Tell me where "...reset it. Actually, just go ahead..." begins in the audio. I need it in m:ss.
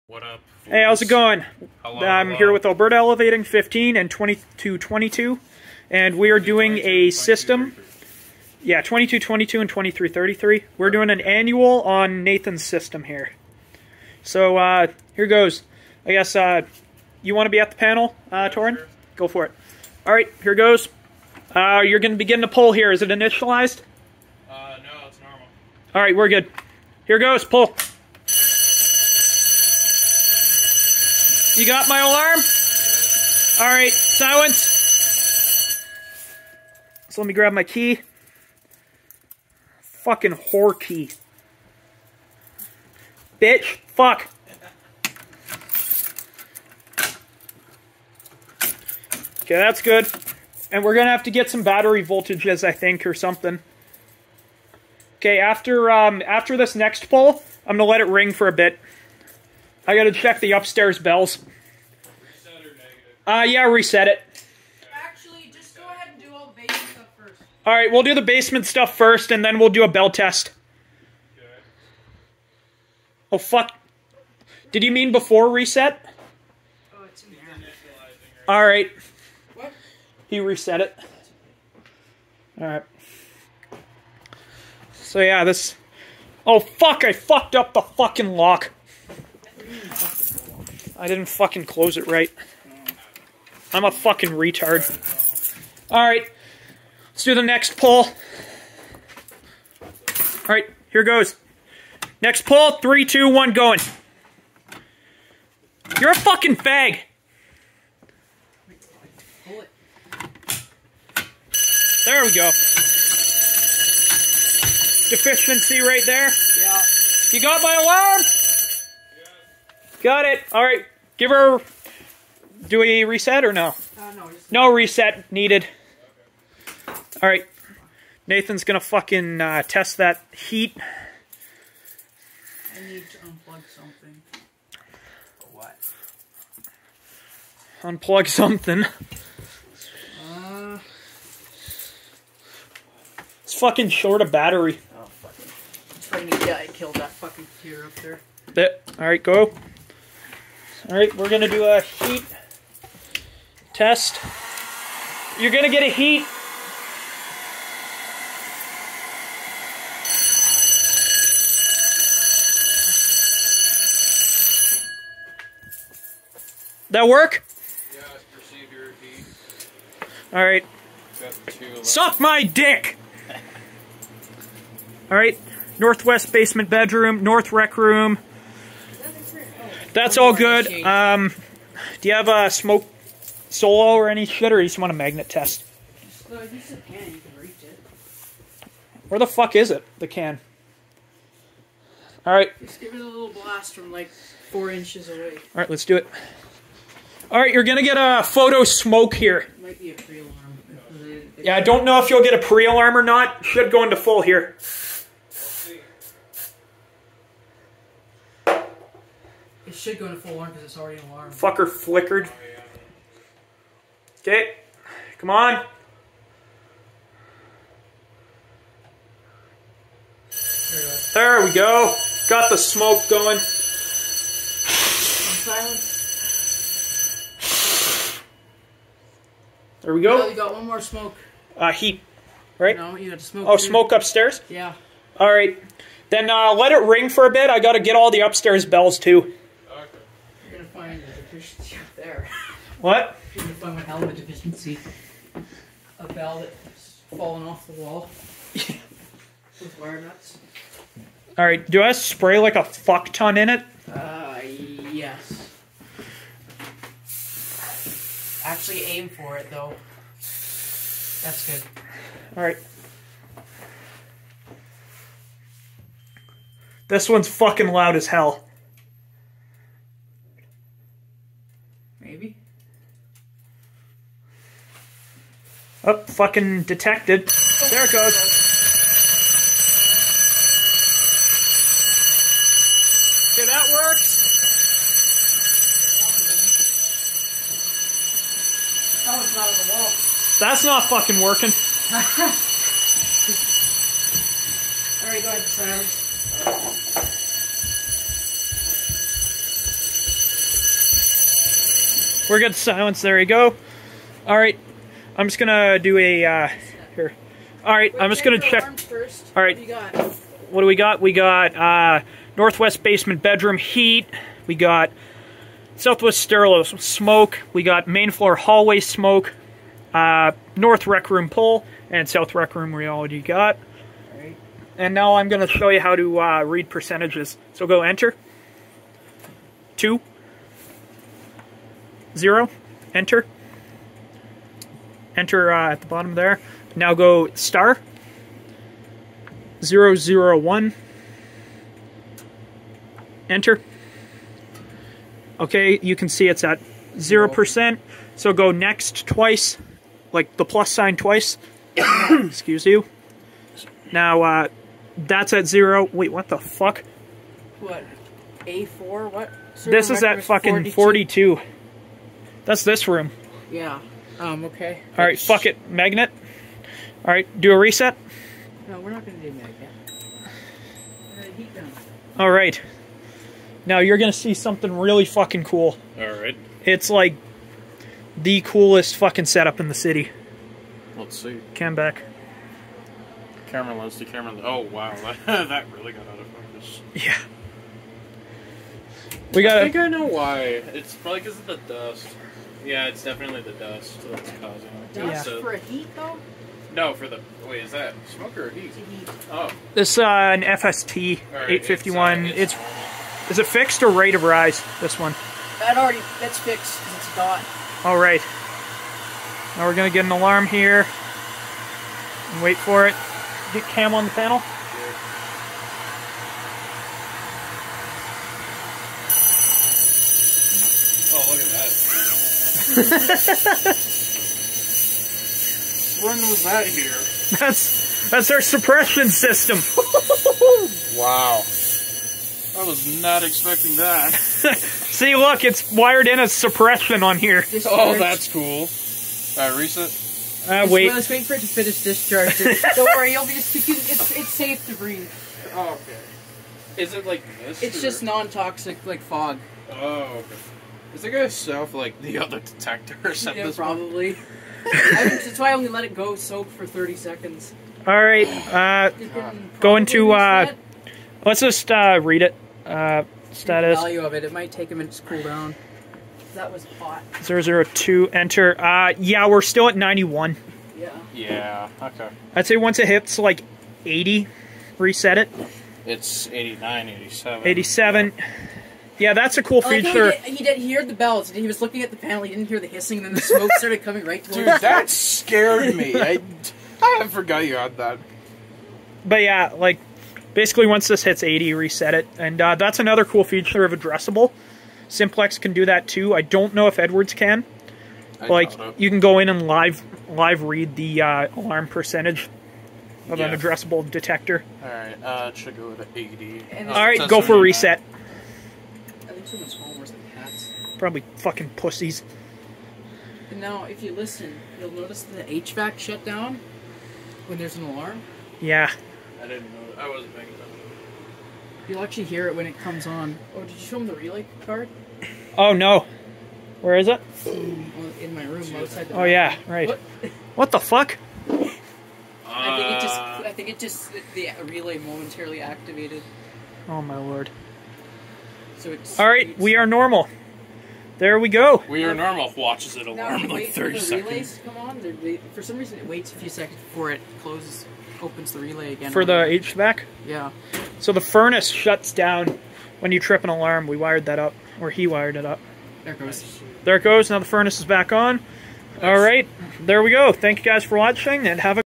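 1:03.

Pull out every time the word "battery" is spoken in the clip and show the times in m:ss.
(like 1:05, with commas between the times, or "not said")
0:51, 2:24.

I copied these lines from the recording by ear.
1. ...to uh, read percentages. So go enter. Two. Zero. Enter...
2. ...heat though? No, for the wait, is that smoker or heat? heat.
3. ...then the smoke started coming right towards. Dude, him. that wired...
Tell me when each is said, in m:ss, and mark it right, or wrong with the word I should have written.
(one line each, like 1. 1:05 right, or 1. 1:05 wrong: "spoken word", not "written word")
1. 5:25 right
2. 6:35 right
3. 8:03 wrong: "scared", not "wired".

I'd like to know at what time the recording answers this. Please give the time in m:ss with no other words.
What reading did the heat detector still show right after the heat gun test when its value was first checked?
7:49.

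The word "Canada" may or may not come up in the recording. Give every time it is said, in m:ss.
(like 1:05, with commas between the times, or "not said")
not said.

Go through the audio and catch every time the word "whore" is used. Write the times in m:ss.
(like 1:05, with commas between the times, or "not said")
0:40.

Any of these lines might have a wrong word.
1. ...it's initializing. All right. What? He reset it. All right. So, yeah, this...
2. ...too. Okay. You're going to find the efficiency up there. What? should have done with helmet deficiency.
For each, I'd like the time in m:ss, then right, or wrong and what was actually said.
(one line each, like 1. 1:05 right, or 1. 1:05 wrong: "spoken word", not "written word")
1. 1:17 right
2. 3:58 right.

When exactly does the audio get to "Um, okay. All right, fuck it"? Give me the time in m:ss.
6:04.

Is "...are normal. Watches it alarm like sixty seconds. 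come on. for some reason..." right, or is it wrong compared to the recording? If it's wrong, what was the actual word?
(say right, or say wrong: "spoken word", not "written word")
wrong: "thirty", not "sixty".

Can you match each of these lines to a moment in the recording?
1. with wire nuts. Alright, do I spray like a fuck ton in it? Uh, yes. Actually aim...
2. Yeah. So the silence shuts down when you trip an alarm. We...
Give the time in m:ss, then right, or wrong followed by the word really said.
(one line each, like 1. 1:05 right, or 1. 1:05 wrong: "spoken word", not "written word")
1. 4:08 right
2. 9:10 wrong: "furnace", not "silence".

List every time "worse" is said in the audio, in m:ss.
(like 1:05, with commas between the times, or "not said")
8:29.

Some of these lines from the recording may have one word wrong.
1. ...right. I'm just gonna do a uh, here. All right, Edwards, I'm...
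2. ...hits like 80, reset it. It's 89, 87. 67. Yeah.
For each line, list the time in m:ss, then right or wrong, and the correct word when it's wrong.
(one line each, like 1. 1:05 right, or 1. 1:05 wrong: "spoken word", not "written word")
1. 5:04 wrong: "Wait", not "Edwards"
2. 7:52 wrong: "87", not "67".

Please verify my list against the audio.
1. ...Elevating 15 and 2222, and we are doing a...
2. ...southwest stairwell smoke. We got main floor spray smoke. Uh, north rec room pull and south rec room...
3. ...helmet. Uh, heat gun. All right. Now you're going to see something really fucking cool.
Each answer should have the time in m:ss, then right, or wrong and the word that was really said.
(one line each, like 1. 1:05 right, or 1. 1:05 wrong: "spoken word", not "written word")
1. 0:02 right
2. 5:15 wrong: "hallway", not "spray"
3. 6:09 wrong: "magnet", not "helmet".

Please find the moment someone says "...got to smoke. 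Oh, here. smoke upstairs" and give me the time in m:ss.
3:53.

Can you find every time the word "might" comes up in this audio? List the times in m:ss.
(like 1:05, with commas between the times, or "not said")
3:19, 7:44.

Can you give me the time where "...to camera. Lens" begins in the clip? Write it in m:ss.
6:23.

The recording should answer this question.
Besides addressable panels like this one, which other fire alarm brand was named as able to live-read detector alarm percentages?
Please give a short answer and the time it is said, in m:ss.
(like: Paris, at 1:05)
Simplex, at 8:14.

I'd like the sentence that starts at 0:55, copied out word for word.
Okay, after um, after this next pull, I'm going to let it ring for a bit.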